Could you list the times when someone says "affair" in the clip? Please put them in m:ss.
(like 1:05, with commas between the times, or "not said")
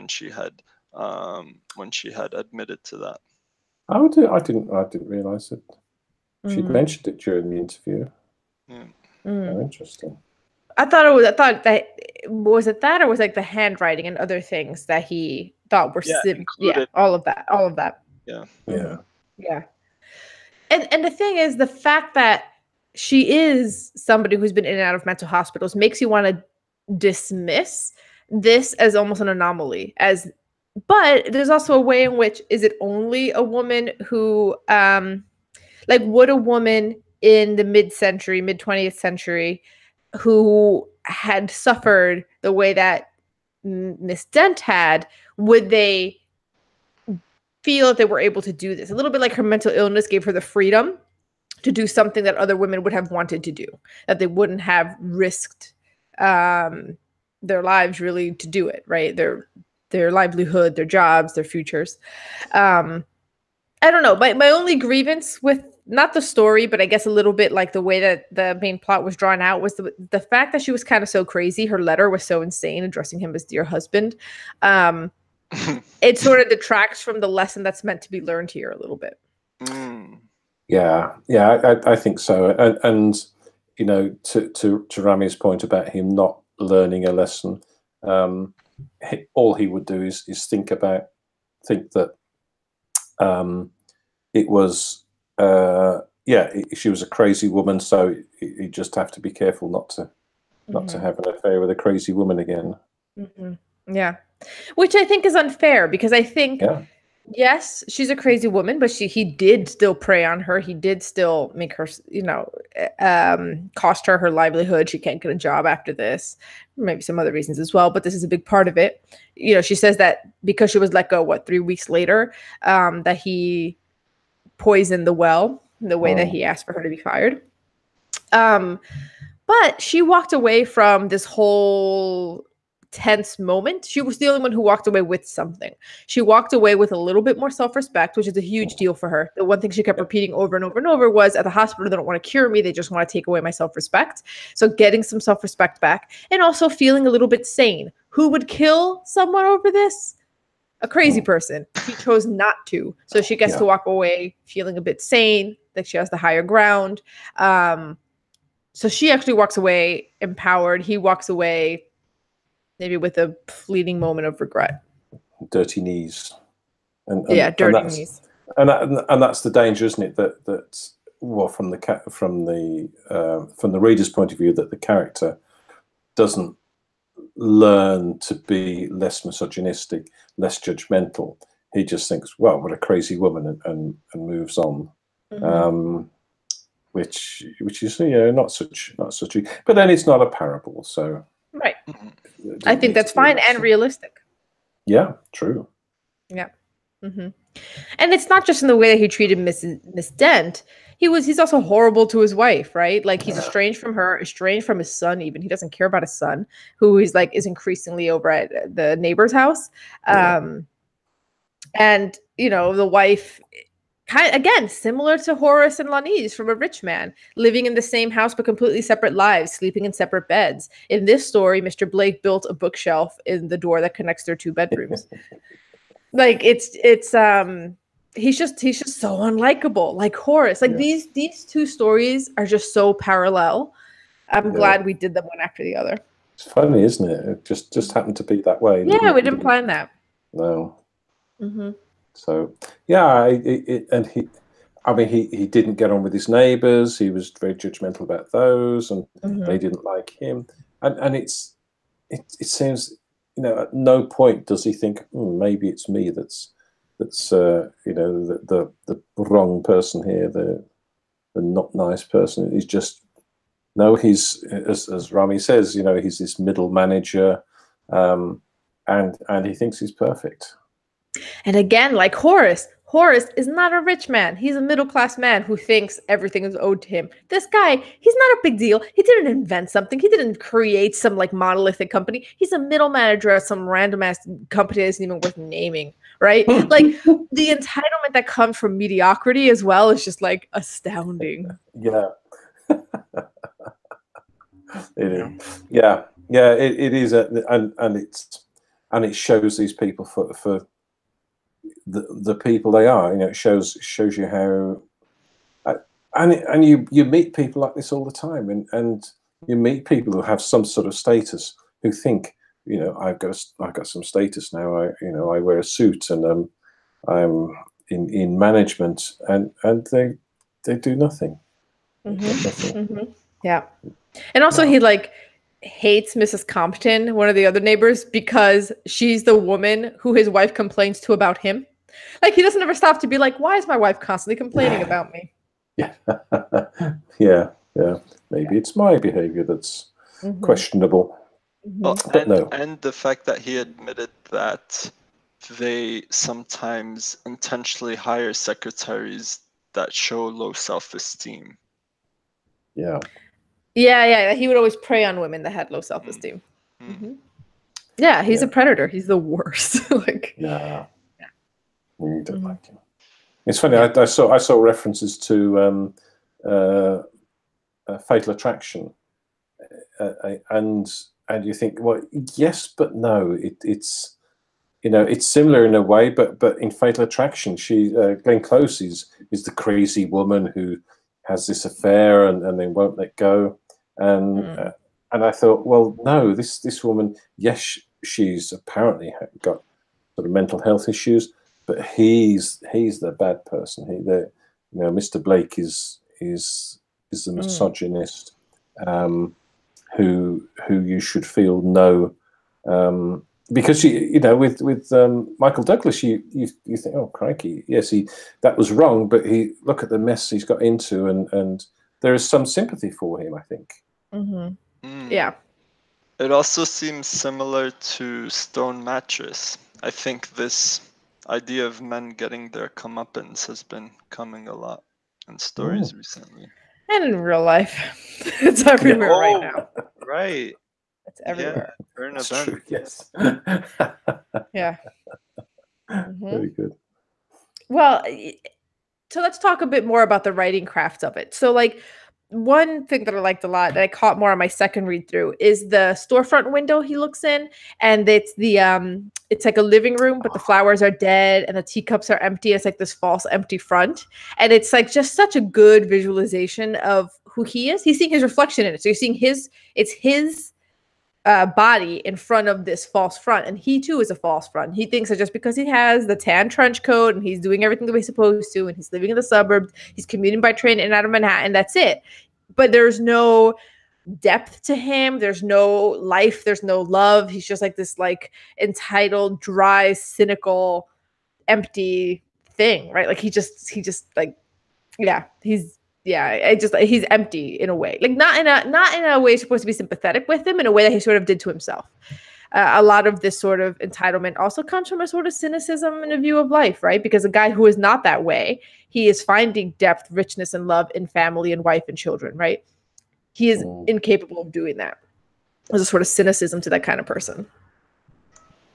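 1:41, 6:21.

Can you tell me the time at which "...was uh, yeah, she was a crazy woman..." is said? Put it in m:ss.
1:34.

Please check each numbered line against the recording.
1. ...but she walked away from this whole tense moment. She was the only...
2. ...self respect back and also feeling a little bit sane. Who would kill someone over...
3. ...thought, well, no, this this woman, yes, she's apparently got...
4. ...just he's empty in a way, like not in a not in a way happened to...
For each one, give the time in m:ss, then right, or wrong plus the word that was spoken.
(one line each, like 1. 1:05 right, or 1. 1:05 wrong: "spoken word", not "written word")
1. 2:09 right
2. 2:25 right
3. 6:25 right
4. 8:06 wrong: "supposed", not "happened".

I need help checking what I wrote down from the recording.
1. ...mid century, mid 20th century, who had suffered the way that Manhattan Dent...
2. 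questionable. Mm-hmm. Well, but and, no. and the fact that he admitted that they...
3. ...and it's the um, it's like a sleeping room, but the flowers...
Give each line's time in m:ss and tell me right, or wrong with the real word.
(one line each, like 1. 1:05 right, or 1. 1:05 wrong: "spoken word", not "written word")
1. 0:37 wrong: "Miss", not "Manhattan"
2. 5:40 right
3. 7:27 wrong: "living", not "sleeping".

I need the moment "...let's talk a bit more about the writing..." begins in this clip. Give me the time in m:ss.
7:19.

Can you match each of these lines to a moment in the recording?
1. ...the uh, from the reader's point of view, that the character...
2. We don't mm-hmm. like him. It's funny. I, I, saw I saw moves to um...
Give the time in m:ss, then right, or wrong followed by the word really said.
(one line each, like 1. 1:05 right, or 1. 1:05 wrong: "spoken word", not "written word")
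1. 2:52 right
2. 6:01 wrong: "references", not "moves".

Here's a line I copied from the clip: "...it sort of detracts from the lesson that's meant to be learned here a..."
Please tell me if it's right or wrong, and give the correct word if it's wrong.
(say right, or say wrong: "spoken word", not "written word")
right.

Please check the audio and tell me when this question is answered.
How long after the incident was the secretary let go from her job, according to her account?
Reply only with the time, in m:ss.
2:01.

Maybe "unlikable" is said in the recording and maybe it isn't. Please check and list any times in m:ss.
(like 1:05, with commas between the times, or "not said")
3:49.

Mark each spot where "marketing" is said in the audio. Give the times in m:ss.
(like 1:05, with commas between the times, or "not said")
not said.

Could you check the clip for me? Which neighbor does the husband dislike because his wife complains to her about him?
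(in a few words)
Mrs. Compton.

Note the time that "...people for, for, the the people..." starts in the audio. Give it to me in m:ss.
4:59.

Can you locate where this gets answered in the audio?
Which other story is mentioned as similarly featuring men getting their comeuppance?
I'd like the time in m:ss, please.
6:58.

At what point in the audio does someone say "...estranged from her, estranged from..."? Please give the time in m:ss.
3:23.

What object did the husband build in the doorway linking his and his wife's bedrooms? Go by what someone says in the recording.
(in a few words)
a bookshelf.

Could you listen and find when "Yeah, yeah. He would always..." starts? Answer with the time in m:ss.
5:53.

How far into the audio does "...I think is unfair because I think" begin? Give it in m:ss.
1:44.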